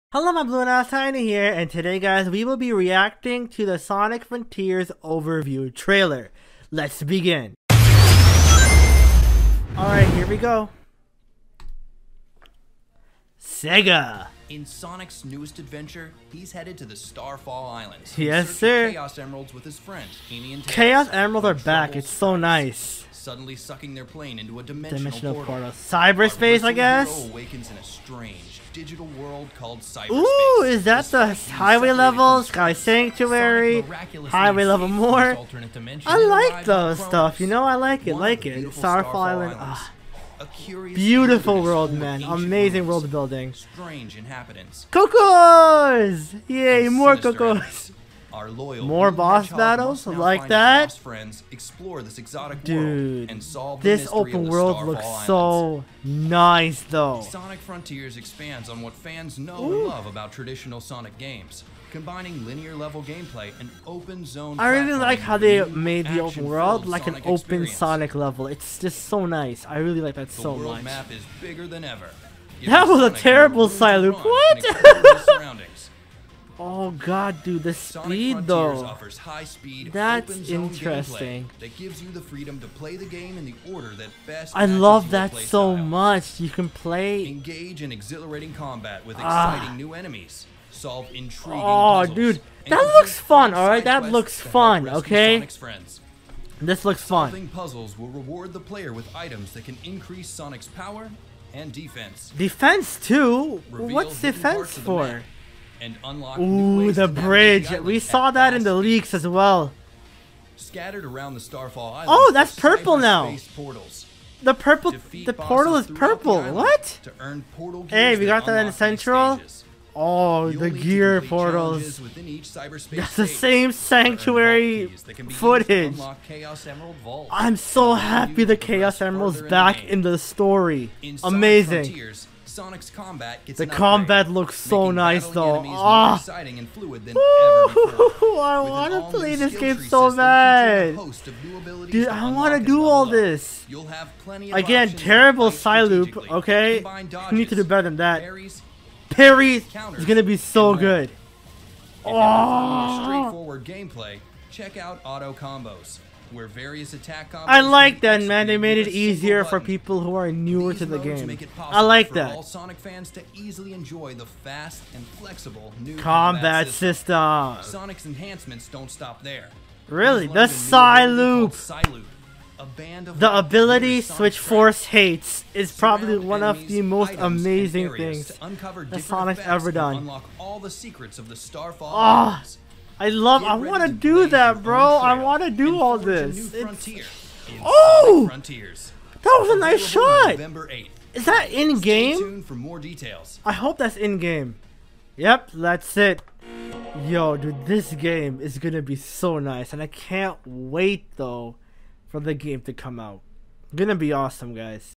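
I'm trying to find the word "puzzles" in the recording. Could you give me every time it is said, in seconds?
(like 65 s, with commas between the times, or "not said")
92 s, 97 s.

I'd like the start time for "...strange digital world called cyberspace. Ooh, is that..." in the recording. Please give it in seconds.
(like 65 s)
27 s.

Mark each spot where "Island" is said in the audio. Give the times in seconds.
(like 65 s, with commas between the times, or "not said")
17 s, 39 s, 111 s.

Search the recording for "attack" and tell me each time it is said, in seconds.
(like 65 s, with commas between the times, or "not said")
156 s.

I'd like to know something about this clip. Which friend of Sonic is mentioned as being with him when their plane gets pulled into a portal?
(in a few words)
Amy.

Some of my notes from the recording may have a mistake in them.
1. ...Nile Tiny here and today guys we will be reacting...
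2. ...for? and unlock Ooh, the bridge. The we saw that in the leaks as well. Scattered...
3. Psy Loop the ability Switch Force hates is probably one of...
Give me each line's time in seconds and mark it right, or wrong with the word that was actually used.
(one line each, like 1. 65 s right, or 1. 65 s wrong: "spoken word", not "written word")
1. 0 s right
2. 104 s right
3. 171 s right.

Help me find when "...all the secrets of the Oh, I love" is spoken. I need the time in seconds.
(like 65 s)
180 s.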